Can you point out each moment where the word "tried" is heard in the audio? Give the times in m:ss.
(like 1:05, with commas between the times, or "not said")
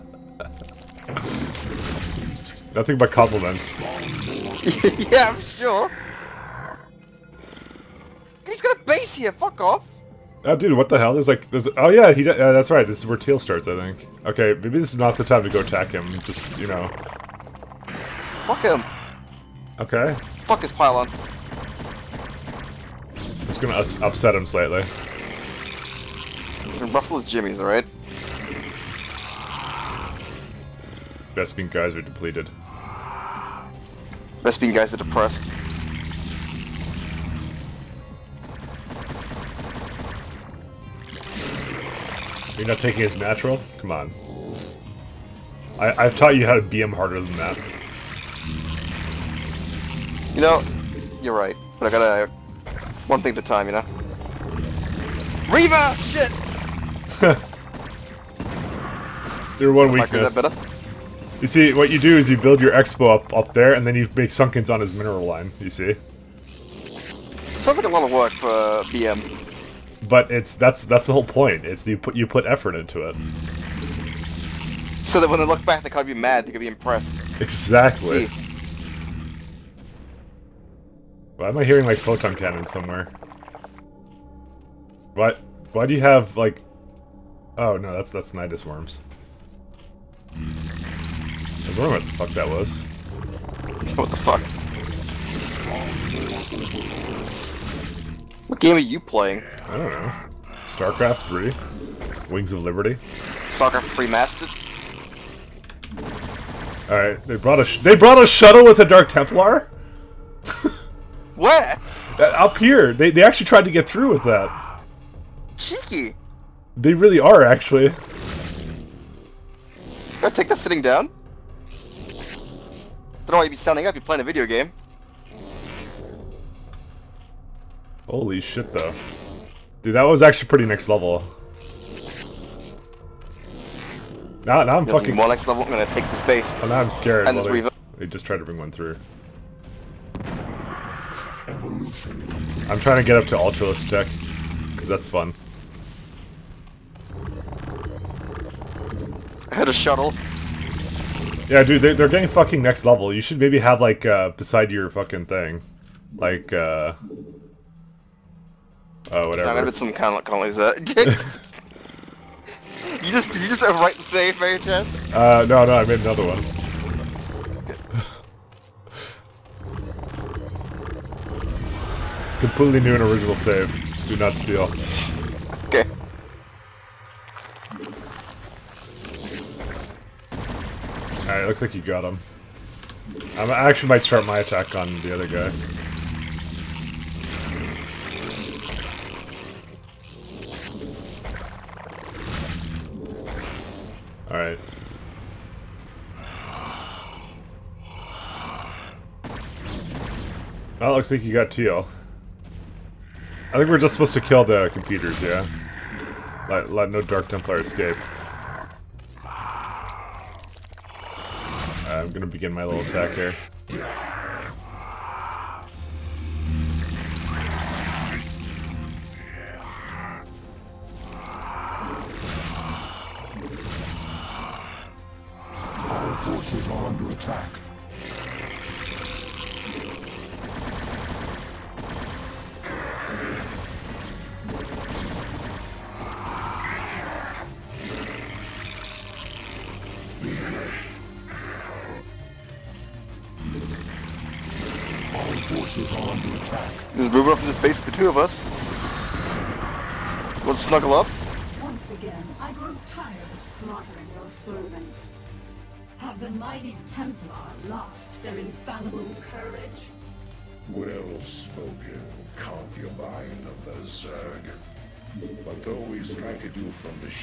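1:53, 2:18.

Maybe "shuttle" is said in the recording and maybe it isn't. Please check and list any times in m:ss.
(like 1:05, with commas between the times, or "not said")
1:48, 2:29.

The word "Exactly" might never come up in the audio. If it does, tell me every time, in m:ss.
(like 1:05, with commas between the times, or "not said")
1:17.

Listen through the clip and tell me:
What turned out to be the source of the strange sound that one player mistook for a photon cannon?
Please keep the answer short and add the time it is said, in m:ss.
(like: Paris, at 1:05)
Nidus worms, at 1:28.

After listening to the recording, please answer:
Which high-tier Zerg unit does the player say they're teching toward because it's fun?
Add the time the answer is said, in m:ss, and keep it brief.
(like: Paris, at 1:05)
Ultralisk, at 2:23.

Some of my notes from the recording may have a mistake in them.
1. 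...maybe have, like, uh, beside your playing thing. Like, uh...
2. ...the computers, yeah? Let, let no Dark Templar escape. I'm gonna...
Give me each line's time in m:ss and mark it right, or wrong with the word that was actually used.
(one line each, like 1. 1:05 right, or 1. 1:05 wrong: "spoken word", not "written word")
1. 2:33 wrong: "fucking", not "playing"
2. 3:24 right.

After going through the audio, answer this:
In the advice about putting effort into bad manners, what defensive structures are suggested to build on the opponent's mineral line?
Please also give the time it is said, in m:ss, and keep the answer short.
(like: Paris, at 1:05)
Sunkens, at 1:04.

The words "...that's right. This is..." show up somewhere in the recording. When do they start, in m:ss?
0:12.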